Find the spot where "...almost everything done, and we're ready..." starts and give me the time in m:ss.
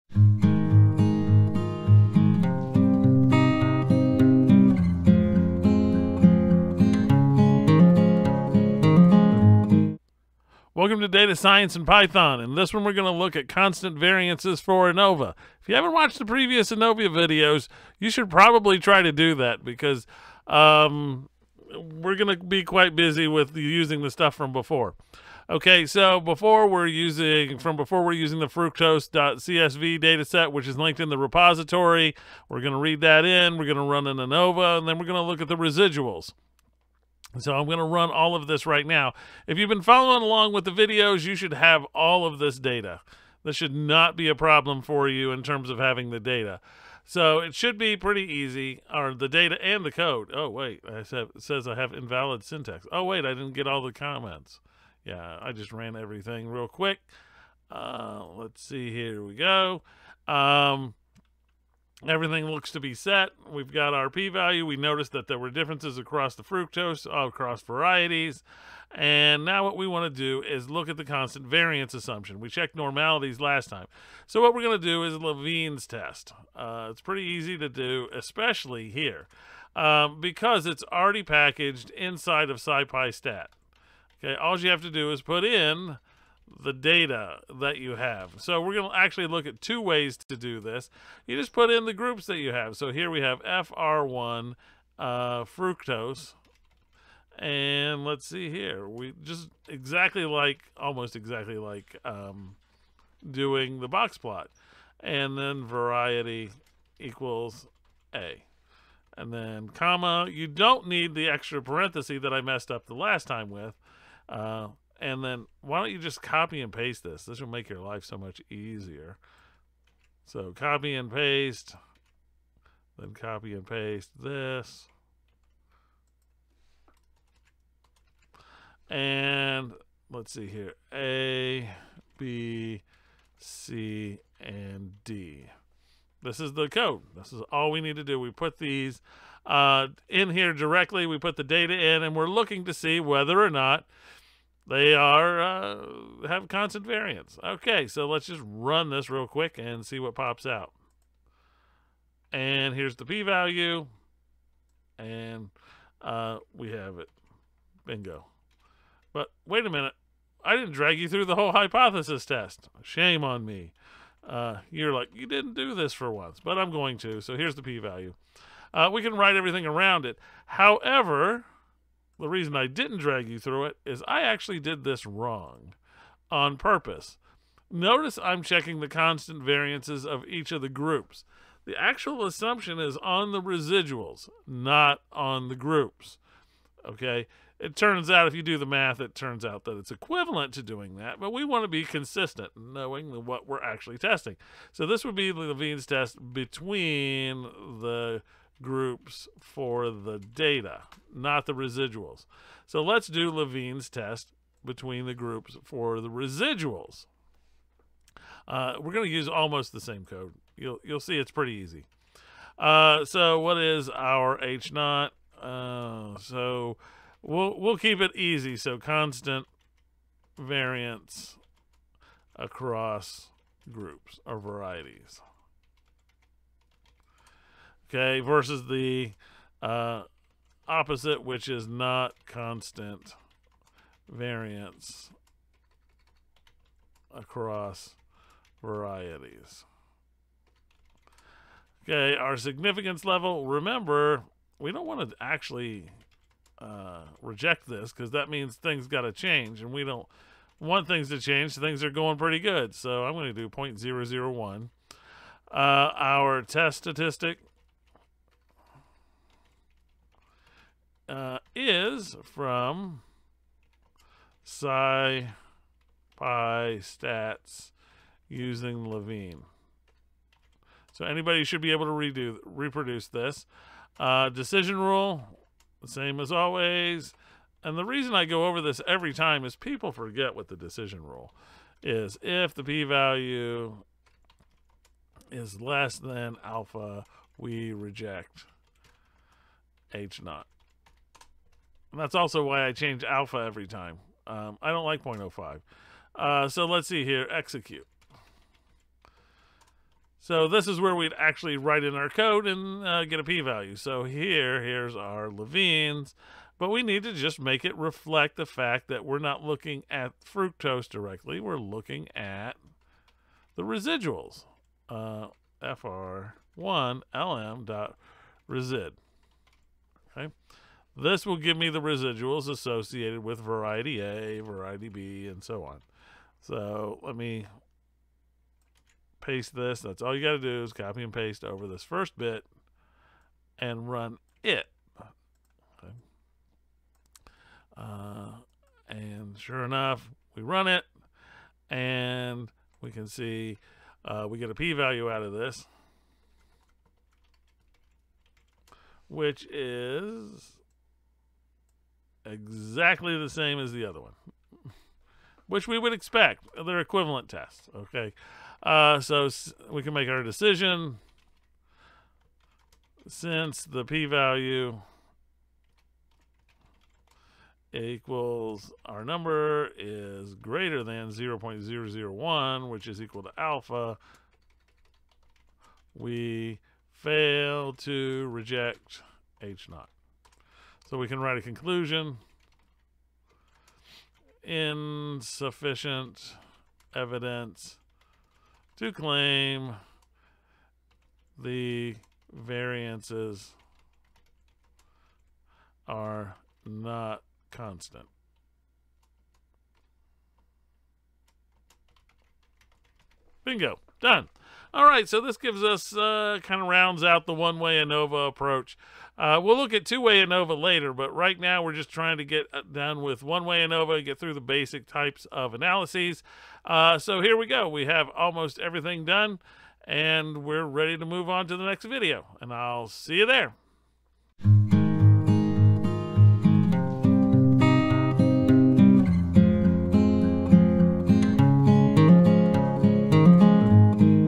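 6:58.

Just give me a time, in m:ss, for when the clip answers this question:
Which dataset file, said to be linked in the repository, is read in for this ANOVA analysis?
0:28.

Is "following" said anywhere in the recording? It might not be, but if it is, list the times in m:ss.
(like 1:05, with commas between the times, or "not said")
0:39.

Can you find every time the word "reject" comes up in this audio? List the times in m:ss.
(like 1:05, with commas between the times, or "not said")
4:07, 4:47, 6:18.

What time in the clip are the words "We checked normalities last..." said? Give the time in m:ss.
1:12.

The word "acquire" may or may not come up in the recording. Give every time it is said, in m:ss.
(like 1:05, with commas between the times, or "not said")
not said.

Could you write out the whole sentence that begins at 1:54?
Uh, and then why don't you just copy and paste this?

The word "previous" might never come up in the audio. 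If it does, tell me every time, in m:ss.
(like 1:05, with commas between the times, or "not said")
0:16.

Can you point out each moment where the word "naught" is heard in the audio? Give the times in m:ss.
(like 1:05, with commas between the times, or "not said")
3:34, 4:50, 6:19.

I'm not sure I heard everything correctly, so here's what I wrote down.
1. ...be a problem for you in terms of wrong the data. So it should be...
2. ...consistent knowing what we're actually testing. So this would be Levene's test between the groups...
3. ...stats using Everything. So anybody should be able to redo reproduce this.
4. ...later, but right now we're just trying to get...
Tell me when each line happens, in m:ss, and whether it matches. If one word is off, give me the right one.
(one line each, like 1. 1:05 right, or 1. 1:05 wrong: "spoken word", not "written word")
1. 0:44 wrong: "having", not "wrong"
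2. 3:11 right
3. 4:26 wrong: "Levene", not "Everything"
4. 6:50 right.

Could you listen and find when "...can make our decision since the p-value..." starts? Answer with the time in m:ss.
5:59.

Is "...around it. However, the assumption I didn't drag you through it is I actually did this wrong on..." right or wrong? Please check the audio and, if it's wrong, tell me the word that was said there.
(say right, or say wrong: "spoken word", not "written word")
wrong: "reason", not "assumption".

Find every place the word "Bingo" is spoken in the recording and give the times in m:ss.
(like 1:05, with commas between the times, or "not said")
2:37, 6:43.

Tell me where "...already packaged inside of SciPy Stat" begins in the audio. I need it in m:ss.
1:20.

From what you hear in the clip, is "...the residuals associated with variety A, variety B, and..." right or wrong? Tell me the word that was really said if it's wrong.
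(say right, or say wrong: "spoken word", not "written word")
right.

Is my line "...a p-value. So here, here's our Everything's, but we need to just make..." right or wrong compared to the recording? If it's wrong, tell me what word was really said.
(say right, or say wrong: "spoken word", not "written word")
wrong: "Levene", not "Everything".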